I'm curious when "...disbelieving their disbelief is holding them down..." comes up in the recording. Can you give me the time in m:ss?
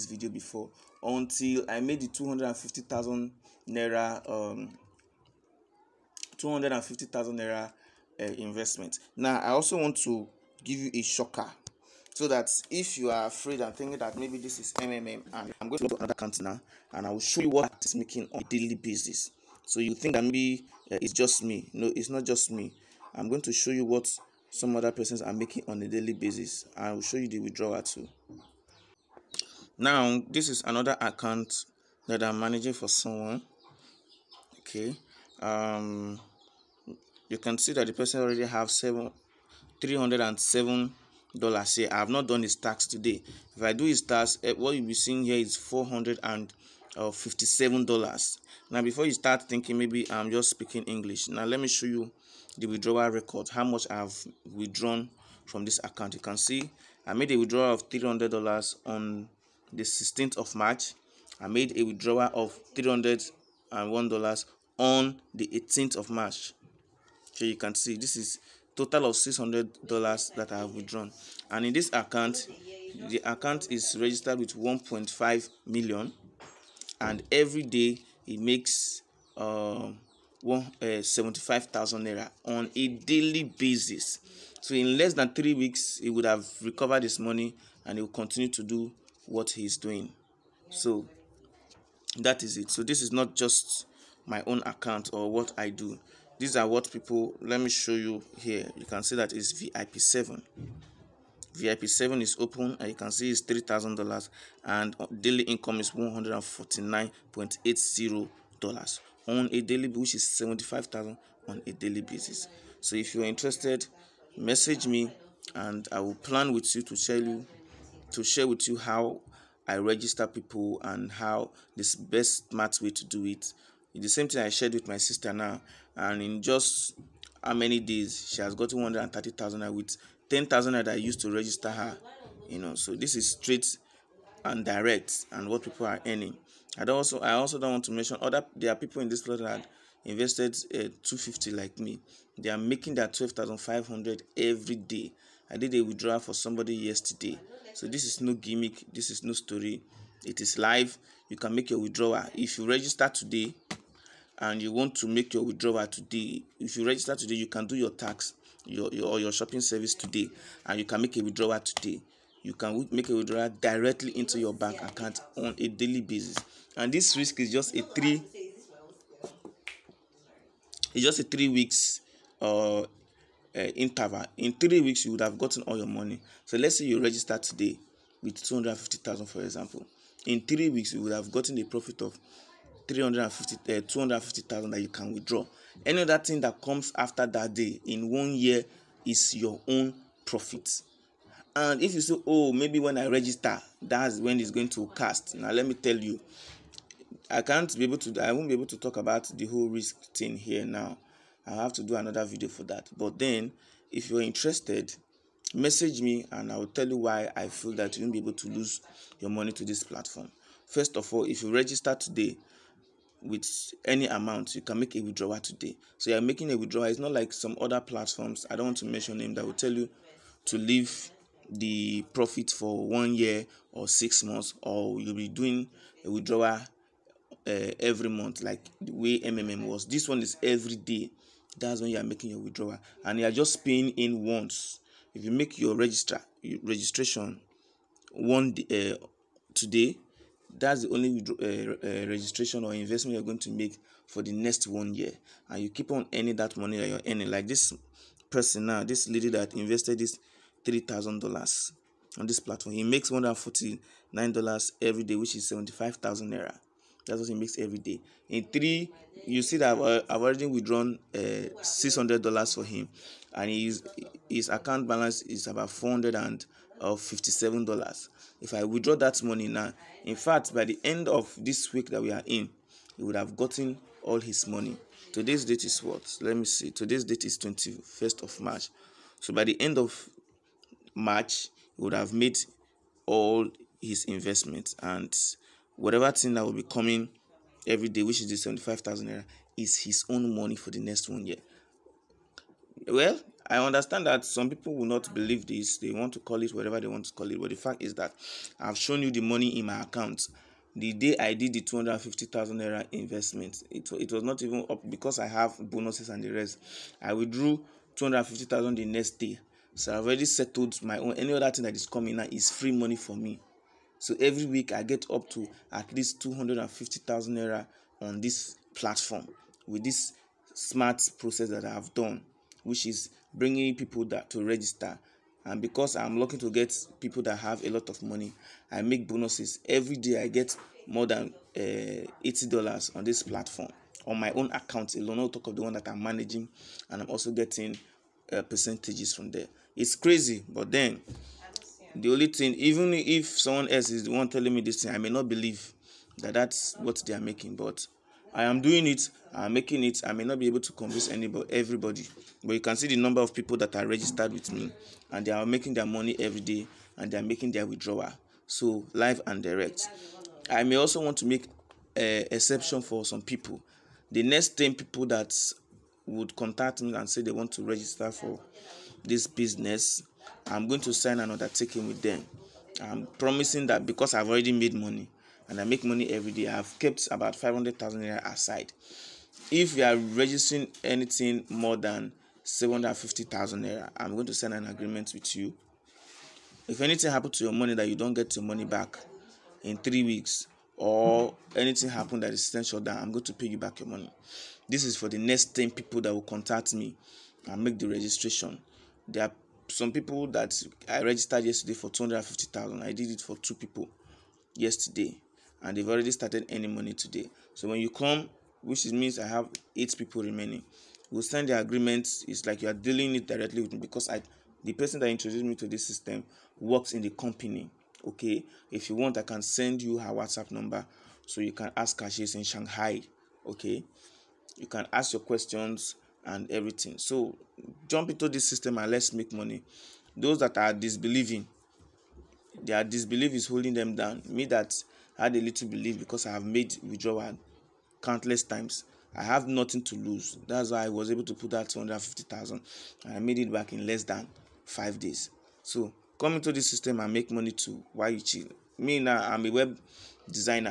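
7:10.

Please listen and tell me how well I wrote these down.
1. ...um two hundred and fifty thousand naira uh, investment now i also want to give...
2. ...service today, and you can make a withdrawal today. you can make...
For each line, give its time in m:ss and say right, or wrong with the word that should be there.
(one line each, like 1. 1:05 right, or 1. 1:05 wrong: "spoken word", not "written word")
1. 0:04 right
2. 2:39 right.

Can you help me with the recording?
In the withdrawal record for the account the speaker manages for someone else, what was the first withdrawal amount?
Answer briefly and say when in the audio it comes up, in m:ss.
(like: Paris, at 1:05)
$300, at 0:57.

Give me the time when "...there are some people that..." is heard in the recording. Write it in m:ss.
6:39.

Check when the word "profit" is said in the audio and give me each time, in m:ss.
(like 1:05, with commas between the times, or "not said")
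3:01, 3:10, 3:42.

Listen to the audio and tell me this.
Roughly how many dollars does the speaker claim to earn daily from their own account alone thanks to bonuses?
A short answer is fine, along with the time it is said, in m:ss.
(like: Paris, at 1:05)
$80, at 5:32.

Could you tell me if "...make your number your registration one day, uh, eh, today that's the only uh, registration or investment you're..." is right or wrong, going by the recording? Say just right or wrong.
wrong.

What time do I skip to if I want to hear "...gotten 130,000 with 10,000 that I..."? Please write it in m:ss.
2:08.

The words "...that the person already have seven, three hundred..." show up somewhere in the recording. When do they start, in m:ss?
0:37.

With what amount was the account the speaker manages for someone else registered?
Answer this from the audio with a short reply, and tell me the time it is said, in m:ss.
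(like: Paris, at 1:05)
1.5 million, at 1:14.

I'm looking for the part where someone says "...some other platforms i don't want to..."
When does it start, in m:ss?
3:37.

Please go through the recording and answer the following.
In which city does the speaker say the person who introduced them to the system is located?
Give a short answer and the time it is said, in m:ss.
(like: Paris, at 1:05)
Shanghai, at 7:02.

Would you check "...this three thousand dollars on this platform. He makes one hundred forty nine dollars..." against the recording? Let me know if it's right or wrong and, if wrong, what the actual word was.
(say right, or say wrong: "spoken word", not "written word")
right.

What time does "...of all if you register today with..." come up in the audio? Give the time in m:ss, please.
3:30.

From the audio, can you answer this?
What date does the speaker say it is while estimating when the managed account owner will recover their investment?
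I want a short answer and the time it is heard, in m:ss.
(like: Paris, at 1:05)
21st of March, at 4:37.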